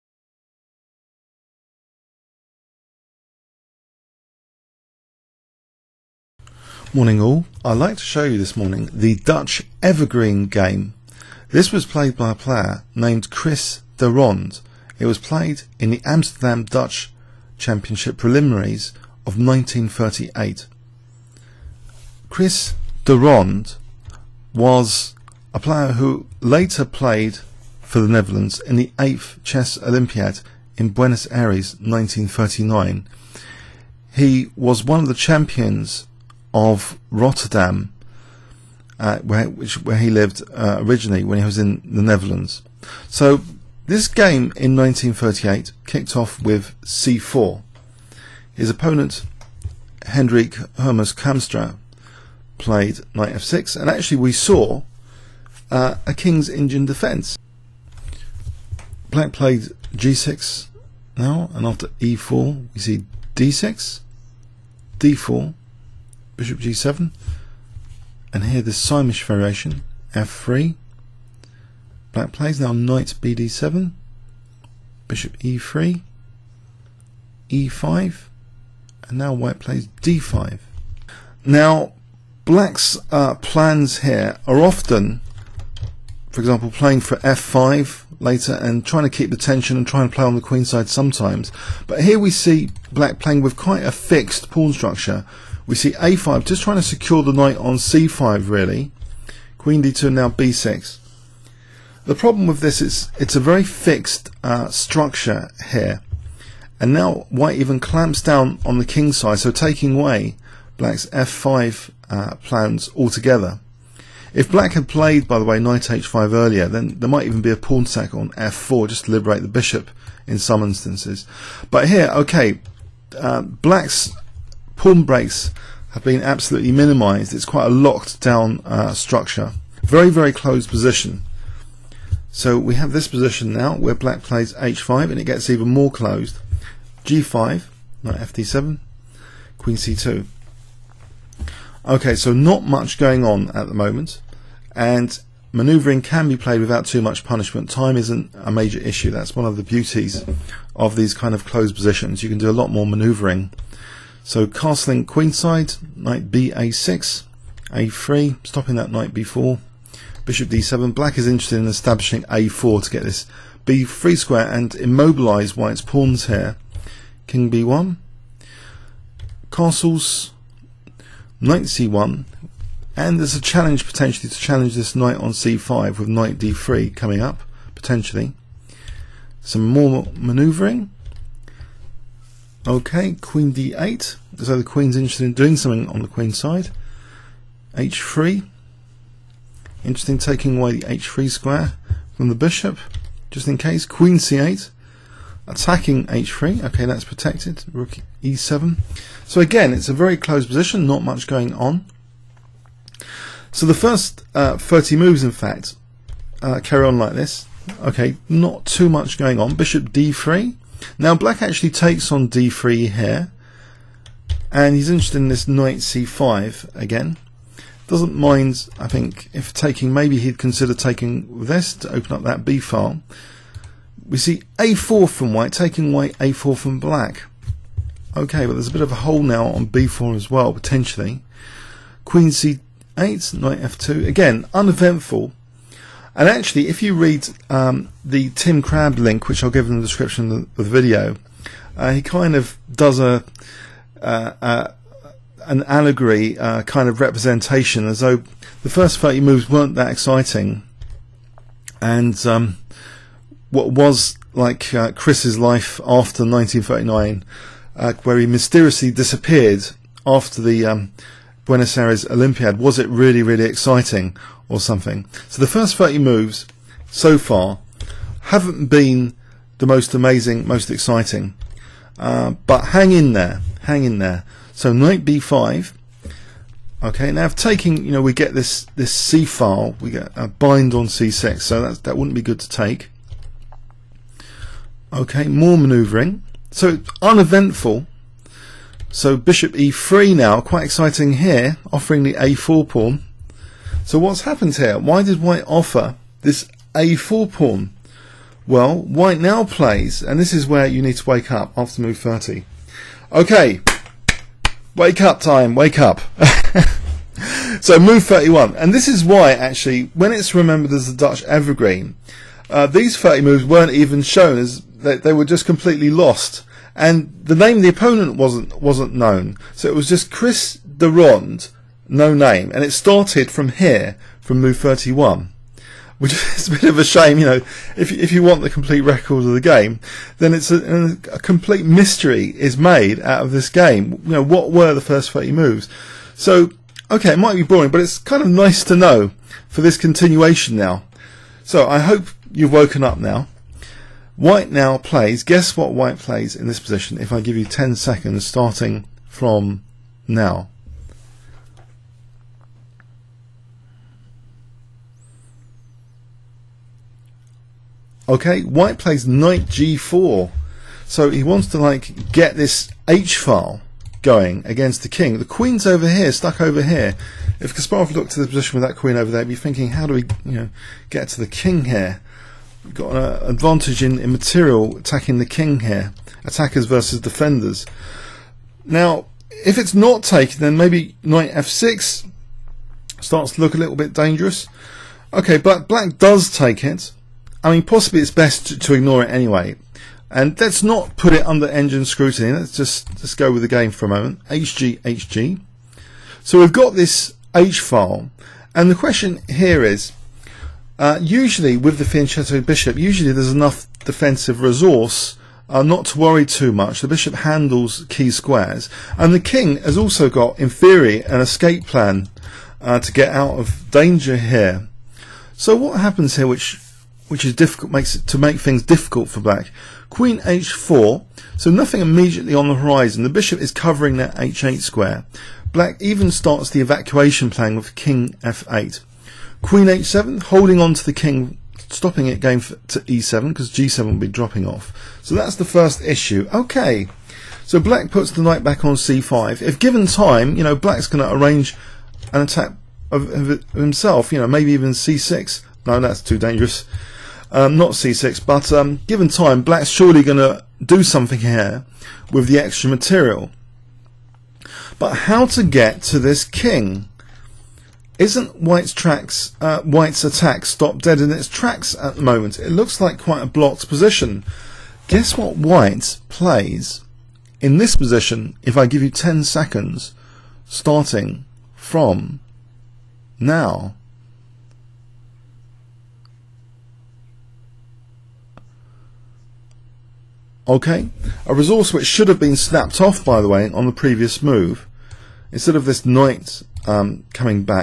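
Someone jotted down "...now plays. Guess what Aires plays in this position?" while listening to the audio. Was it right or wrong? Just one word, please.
wrong.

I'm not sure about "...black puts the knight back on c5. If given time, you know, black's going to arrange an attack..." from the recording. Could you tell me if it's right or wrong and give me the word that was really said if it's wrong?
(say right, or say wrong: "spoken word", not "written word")
right.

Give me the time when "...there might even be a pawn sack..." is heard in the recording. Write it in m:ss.
1:56.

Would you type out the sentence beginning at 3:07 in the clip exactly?
h3, Interesting, taking away the h3 square from the bishop, just in case.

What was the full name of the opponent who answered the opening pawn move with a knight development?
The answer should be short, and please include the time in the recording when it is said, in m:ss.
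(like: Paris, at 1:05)
Hendrik Hermes Kamstra, at 0:50.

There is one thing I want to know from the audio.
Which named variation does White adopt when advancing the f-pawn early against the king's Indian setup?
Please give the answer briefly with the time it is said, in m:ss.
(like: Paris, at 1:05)
Sämisch variation, at 1:08.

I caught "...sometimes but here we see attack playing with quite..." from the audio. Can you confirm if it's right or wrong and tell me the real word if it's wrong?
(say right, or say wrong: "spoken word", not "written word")
wrong: "black", not "attack".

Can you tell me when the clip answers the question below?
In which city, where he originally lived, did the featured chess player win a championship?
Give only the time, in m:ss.
0:37.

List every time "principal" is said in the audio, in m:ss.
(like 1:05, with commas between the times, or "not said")
not said.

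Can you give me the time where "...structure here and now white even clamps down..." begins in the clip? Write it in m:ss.
1:44.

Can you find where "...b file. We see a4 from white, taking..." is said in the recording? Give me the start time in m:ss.
3:42.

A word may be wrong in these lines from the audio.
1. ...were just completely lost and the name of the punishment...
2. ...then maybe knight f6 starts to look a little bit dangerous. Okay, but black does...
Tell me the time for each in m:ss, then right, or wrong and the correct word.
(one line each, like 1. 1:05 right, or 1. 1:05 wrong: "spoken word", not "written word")
1. 5:15 wrong: "opponent", not "punishment"
2. 6:20 right.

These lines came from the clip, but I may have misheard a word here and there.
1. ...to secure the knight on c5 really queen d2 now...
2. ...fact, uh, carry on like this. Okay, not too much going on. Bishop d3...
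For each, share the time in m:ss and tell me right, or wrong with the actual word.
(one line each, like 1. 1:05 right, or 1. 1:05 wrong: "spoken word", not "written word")
1. 1:36 right
2. 3:25 right.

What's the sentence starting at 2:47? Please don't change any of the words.
King b1, castles, knight c1, and there's a challenge potentially to challenge this knight on c5 with knight d3 coming up, potentially.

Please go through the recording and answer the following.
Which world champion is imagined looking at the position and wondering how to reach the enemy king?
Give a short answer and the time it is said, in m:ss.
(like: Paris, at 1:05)
Kasparov, at 6:07.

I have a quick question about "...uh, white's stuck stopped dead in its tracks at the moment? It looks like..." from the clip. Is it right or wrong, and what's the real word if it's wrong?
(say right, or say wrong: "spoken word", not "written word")
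wrong: "attack", not "stuck".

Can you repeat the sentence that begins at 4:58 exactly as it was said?
Well, White now plays, and this is where you need to wake up after move 30.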